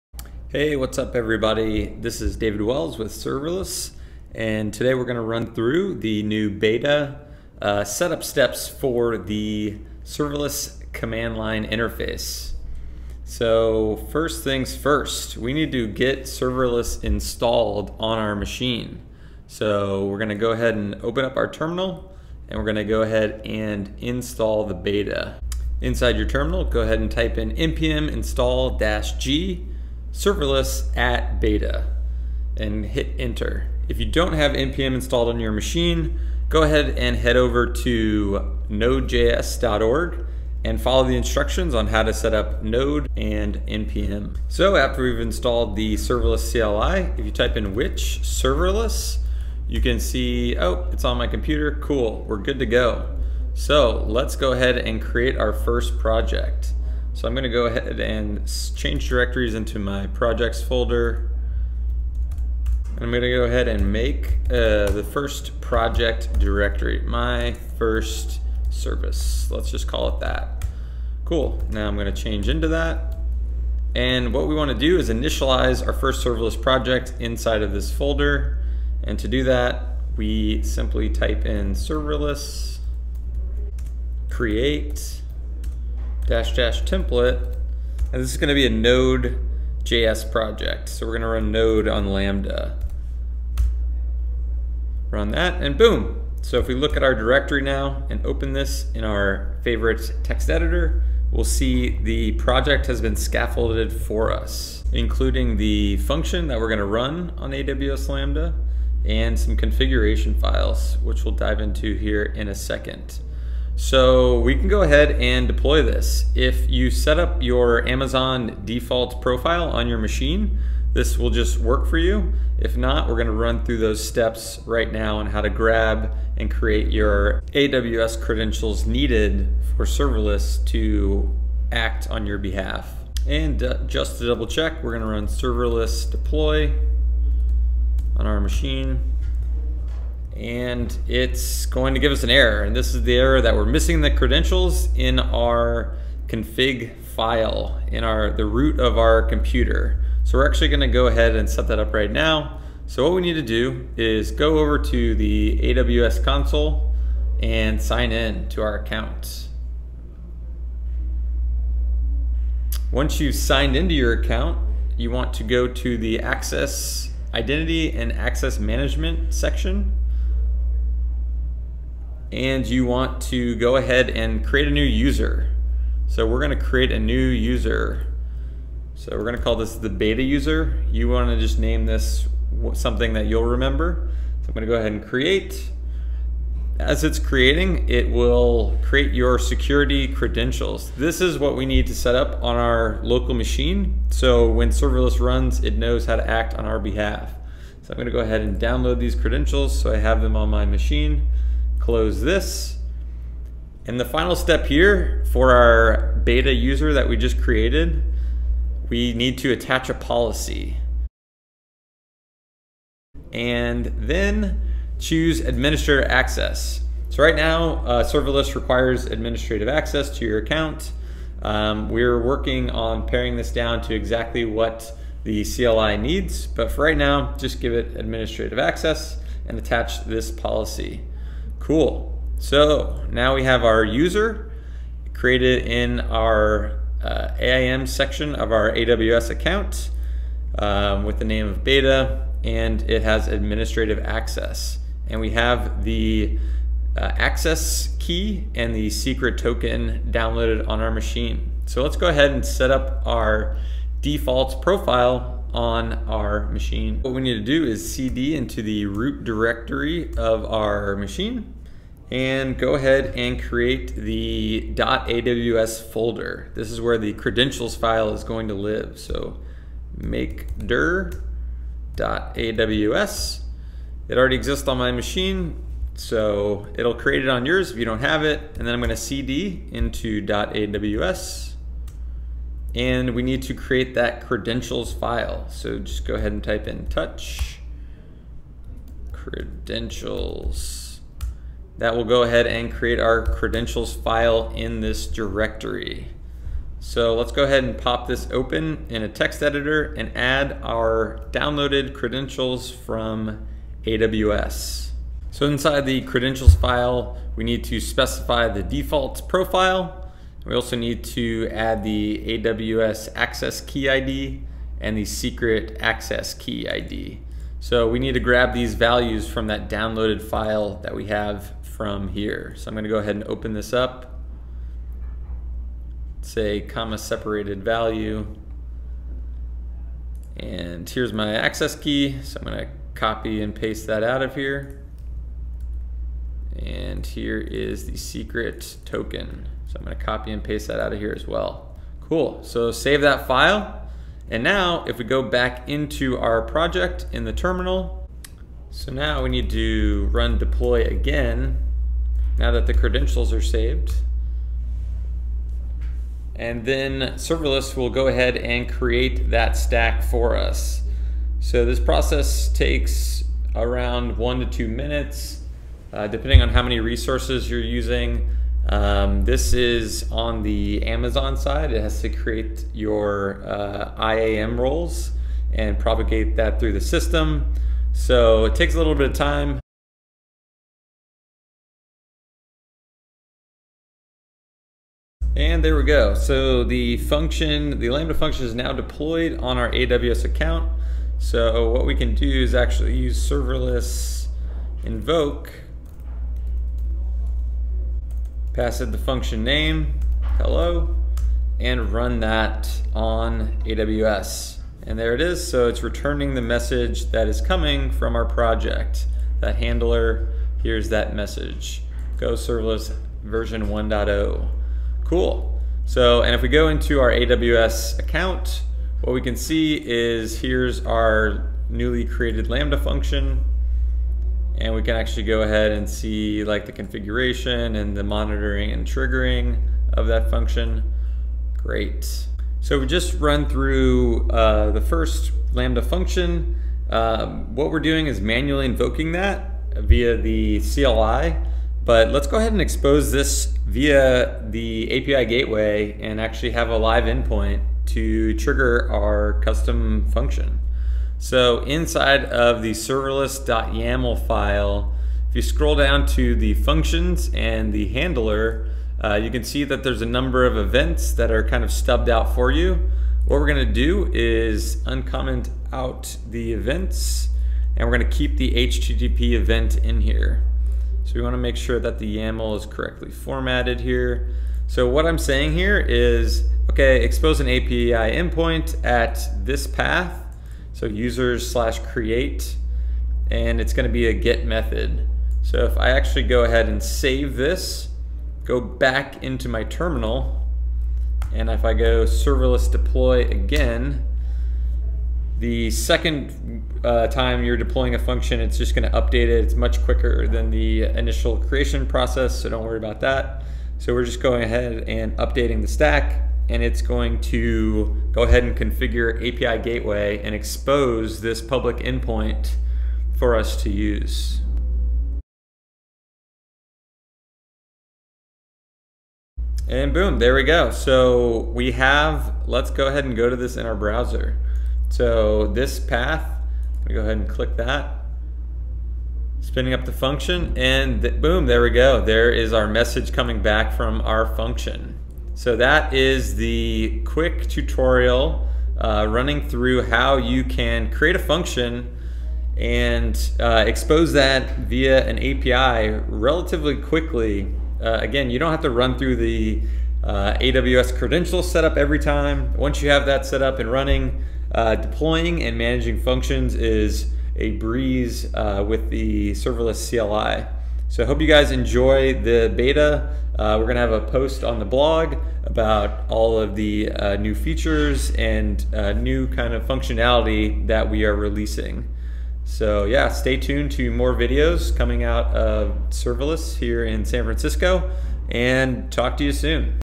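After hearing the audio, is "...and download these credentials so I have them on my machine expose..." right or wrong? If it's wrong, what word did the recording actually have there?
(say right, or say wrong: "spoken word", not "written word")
wrong: "close", not "expose".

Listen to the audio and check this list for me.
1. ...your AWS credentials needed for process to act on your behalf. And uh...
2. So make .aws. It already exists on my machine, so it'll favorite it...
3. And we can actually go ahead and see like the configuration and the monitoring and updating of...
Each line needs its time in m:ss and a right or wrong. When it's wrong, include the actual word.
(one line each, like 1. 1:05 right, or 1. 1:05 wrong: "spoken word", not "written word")
1. 2:06 wrong: "serverless", not "process"
2. 4:28 wrong: "create", not "favorite"
3. 7:04 wrong: "triggering", not "updating".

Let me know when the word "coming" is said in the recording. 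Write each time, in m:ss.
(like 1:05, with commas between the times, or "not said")
6:47, 8:53, 9:34.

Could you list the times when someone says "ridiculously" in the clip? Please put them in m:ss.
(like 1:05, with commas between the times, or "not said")
not said.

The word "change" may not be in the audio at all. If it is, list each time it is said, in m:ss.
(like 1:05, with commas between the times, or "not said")
0:58, 1:12.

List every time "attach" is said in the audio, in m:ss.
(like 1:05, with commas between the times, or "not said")
3:29, 3:49.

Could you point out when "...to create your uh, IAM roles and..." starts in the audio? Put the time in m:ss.
6:12.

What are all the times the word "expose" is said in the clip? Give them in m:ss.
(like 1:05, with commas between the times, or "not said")
7:22, 7:57, 8:30, 9:03.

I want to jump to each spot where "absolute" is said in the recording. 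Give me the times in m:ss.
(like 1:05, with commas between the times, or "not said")
not said.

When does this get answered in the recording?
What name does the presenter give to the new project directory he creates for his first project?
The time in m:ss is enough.
1:07.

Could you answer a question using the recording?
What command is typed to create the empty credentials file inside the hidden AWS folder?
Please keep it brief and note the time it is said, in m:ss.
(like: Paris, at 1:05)
touch credentials, at 4:46.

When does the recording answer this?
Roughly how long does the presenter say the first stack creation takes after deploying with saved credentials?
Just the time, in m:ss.
6:04.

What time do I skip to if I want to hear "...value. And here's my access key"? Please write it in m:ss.
5:27.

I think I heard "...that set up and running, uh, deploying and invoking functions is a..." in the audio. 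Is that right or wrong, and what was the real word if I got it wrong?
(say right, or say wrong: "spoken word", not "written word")
wrong: "managing", not "invoking".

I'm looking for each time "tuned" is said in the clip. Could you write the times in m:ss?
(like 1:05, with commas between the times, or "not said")
9:33.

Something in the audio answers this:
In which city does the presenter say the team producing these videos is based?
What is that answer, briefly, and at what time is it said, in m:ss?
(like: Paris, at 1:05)
San Francisco, at 9:37.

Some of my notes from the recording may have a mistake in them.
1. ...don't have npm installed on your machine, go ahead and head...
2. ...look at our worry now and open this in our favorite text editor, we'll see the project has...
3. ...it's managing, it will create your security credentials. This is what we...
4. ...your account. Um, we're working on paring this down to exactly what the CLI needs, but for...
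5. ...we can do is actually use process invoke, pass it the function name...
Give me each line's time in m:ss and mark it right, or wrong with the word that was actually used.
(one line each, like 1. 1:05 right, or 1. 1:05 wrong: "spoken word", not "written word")
1. 0:34 right
2. 1:36 wrong: "directory", not "worry"
3. 3:07 wrong: "creating", not "managing"
4. 3:40 right
5. 6:31 wrong: "serverless", not "process".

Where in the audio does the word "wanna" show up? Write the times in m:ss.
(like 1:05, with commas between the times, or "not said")
3:01, 7:51.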